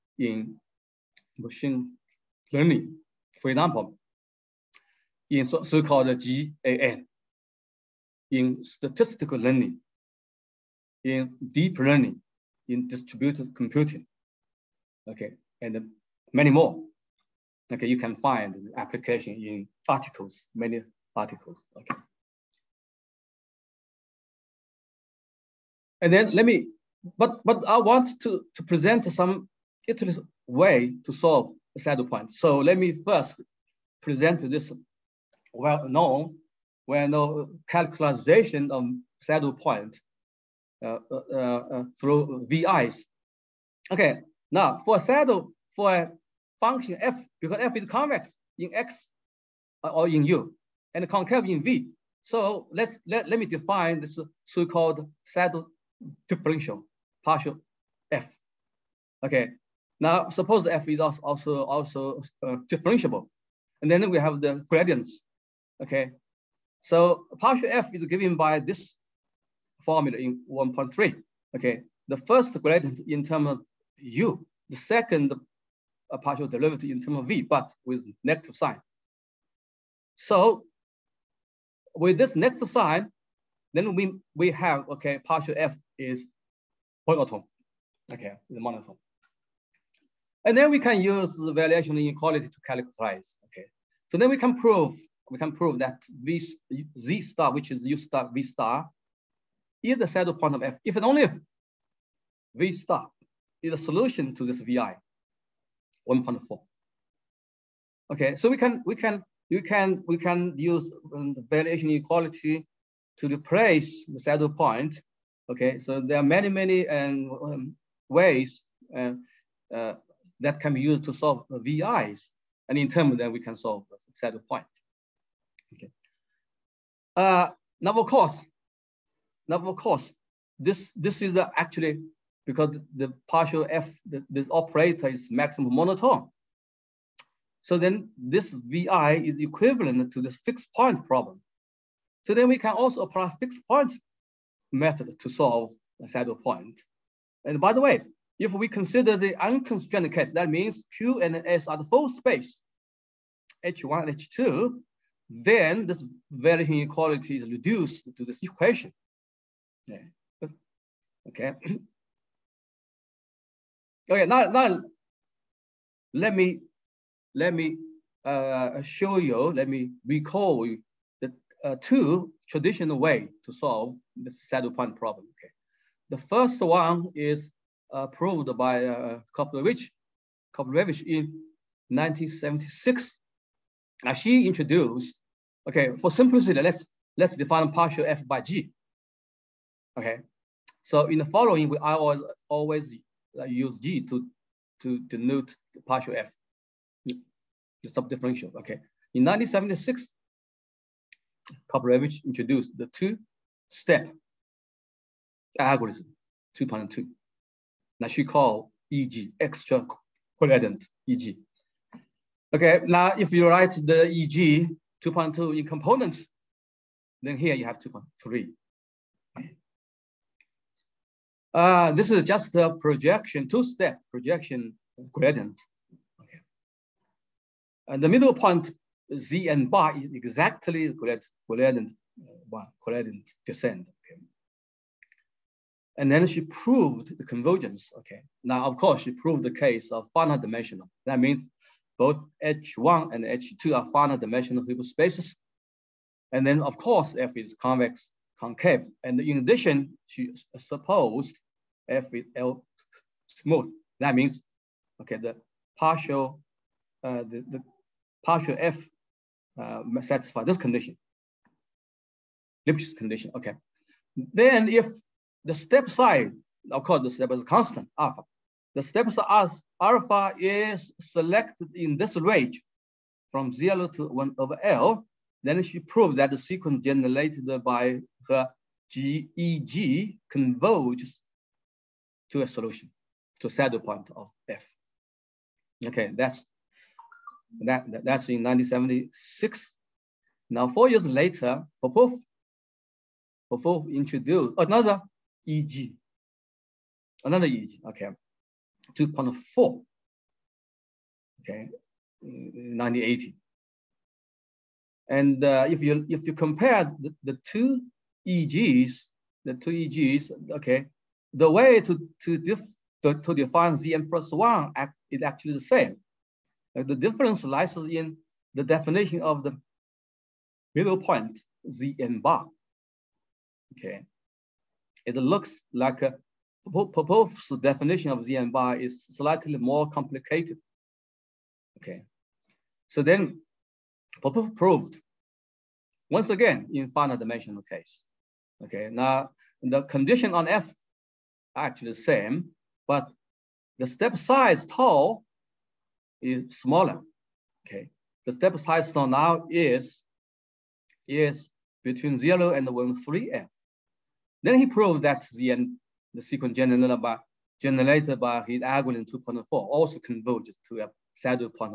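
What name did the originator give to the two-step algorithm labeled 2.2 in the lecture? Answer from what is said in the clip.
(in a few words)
Extra gradient (EG).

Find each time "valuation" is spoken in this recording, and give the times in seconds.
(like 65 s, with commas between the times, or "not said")
156 s.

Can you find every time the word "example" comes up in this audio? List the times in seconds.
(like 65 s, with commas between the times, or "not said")
3 s.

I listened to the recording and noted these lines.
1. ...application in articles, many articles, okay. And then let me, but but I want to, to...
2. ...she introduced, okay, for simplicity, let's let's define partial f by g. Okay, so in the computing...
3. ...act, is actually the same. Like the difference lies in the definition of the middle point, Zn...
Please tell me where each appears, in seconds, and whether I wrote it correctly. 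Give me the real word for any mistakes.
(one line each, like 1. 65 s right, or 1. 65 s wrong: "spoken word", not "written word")
1. 18 s right
2. 184 s wrong: "following", not "computing"
3. 314 s right.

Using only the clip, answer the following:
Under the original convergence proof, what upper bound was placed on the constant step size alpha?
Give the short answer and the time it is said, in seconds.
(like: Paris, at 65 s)
1 over L, at 274 s.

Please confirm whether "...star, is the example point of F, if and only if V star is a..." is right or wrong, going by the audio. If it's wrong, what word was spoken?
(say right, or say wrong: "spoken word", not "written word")
wrong: "saddle", not "example".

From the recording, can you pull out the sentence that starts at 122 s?
And in terms that we can solve set point.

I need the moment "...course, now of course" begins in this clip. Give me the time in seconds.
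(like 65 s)
128 s.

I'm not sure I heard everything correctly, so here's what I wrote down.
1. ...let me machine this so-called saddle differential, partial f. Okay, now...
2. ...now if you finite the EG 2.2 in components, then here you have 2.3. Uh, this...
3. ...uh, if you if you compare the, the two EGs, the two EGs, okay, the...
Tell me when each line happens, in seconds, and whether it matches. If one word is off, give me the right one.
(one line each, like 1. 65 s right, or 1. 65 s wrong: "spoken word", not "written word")
1. 53 s wrong: "define", not "machine"
2. 212 s wrong: "write", not "finite"
3. 305 s right.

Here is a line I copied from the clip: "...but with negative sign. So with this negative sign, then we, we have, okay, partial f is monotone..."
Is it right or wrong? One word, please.
right.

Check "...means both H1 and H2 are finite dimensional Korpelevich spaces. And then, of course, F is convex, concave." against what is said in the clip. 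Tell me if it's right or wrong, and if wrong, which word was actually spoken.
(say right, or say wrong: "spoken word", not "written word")
wrong: "Hilbert", not "Korpelevich".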